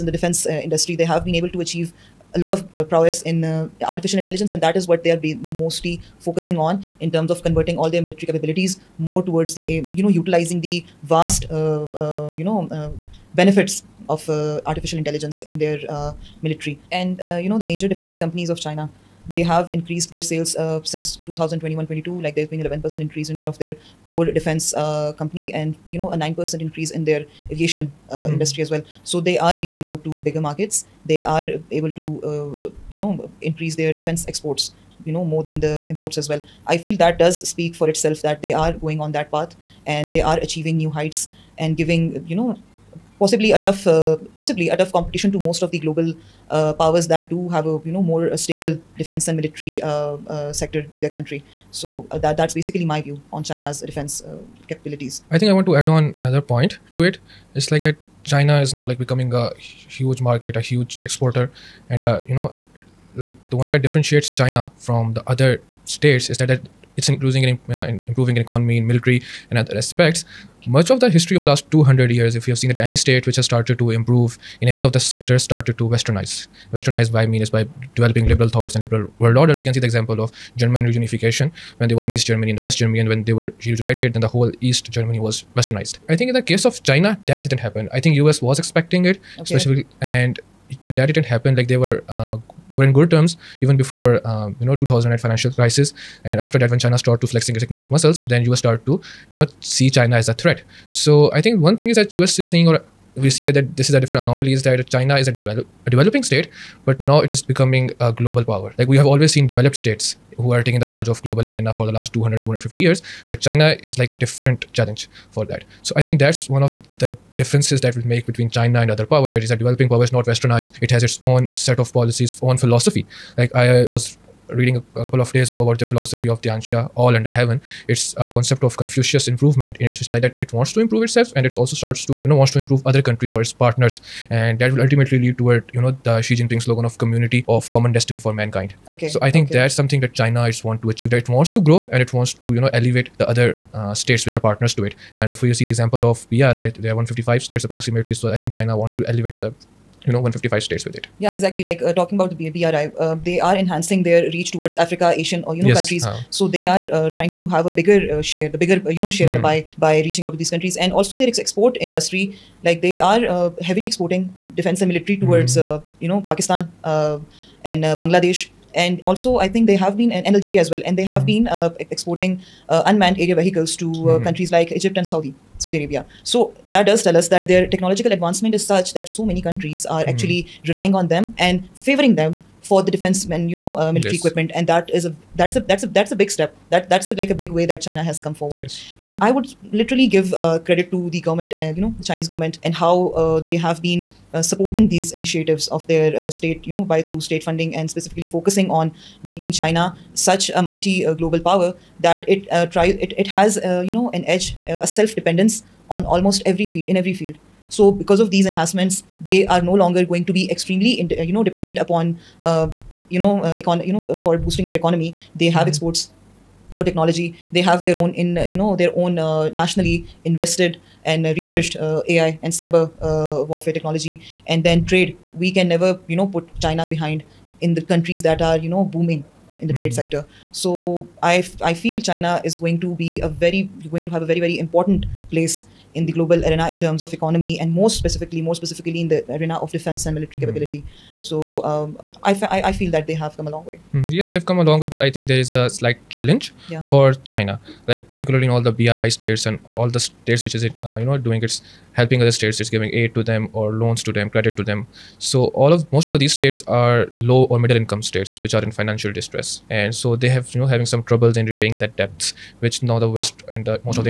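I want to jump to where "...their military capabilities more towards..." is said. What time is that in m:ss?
0:07.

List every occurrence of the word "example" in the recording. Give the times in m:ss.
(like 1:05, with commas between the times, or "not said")
1:19, 2:25.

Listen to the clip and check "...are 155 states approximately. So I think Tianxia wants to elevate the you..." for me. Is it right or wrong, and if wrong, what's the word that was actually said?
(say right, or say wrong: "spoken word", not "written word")
wrong: "China", not "Tianxia".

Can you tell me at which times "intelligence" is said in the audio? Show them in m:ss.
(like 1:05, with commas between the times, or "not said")
0:04, 0:14.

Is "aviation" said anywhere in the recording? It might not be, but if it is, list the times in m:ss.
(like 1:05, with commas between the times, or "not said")
0:27.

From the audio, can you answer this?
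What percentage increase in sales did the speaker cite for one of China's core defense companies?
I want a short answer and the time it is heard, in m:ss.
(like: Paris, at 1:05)
11%, at 0:22.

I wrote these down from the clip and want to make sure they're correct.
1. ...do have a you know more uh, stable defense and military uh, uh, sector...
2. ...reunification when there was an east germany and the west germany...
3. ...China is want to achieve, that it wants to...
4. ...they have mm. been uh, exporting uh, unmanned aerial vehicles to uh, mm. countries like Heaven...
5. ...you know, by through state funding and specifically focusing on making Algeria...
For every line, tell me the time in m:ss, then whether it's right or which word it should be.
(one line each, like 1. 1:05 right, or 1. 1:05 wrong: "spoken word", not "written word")
1. 0:47 right
2. 1:20 right
3. 2:20 right
4. 2:50 wrong: "Egypt", not "Heaven"
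5. 3:16 wrong: "China", not "Algeria".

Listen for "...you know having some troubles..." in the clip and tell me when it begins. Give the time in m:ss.
4:20.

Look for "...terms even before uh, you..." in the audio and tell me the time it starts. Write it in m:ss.
1:33.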